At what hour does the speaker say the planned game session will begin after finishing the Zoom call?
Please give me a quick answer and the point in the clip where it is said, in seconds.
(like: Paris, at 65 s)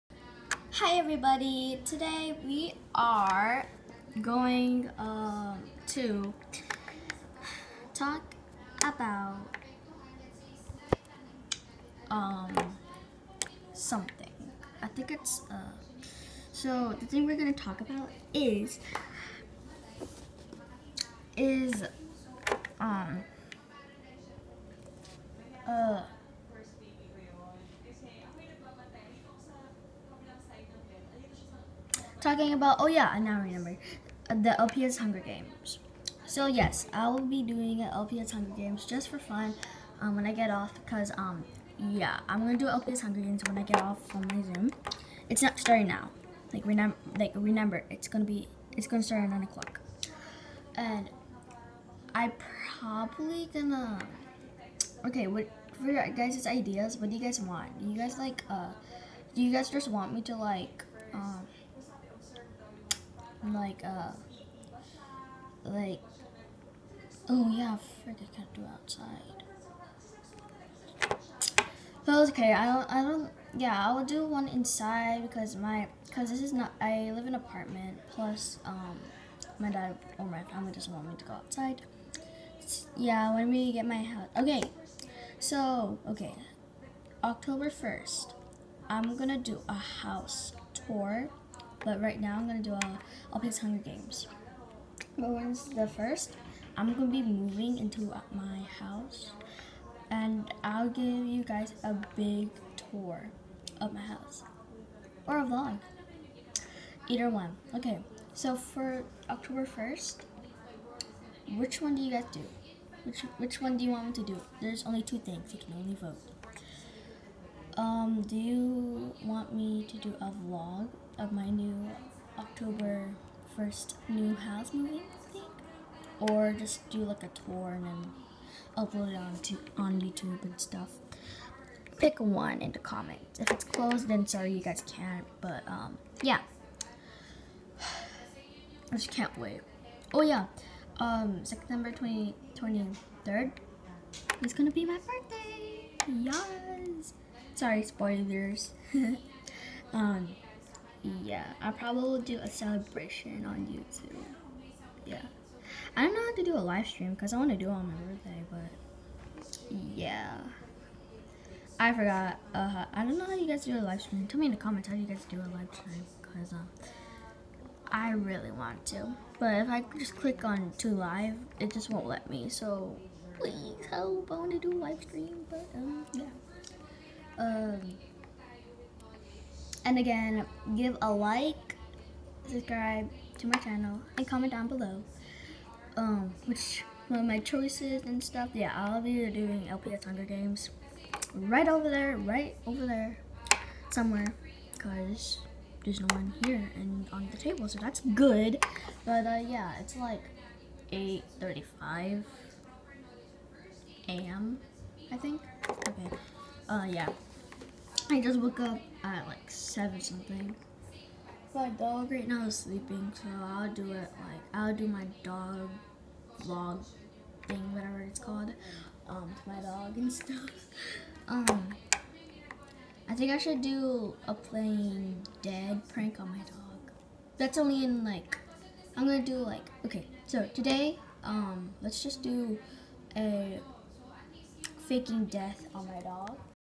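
9 o'clock, at 49 s.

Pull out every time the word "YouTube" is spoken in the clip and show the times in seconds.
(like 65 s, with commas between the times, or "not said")
130 s, 153 s.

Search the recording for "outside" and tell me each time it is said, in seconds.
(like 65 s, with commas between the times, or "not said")
68 s, 81 s.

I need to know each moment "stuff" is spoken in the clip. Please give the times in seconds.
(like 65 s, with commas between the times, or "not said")
130 s, 188 s, 220 s.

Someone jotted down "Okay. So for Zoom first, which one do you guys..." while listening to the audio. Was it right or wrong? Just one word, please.
wrong.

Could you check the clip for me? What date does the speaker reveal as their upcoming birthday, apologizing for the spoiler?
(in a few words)
September 23.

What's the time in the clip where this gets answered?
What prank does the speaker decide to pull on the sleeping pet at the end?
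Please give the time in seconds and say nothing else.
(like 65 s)
234 s.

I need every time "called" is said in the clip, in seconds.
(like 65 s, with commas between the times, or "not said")
218 s.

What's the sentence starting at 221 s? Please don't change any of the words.
Um, I think I should do a plain dead prank on my dog.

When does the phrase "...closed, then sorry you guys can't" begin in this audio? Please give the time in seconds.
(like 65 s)
133 s.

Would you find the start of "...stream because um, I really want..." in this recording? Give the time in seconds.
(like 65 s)
165 s.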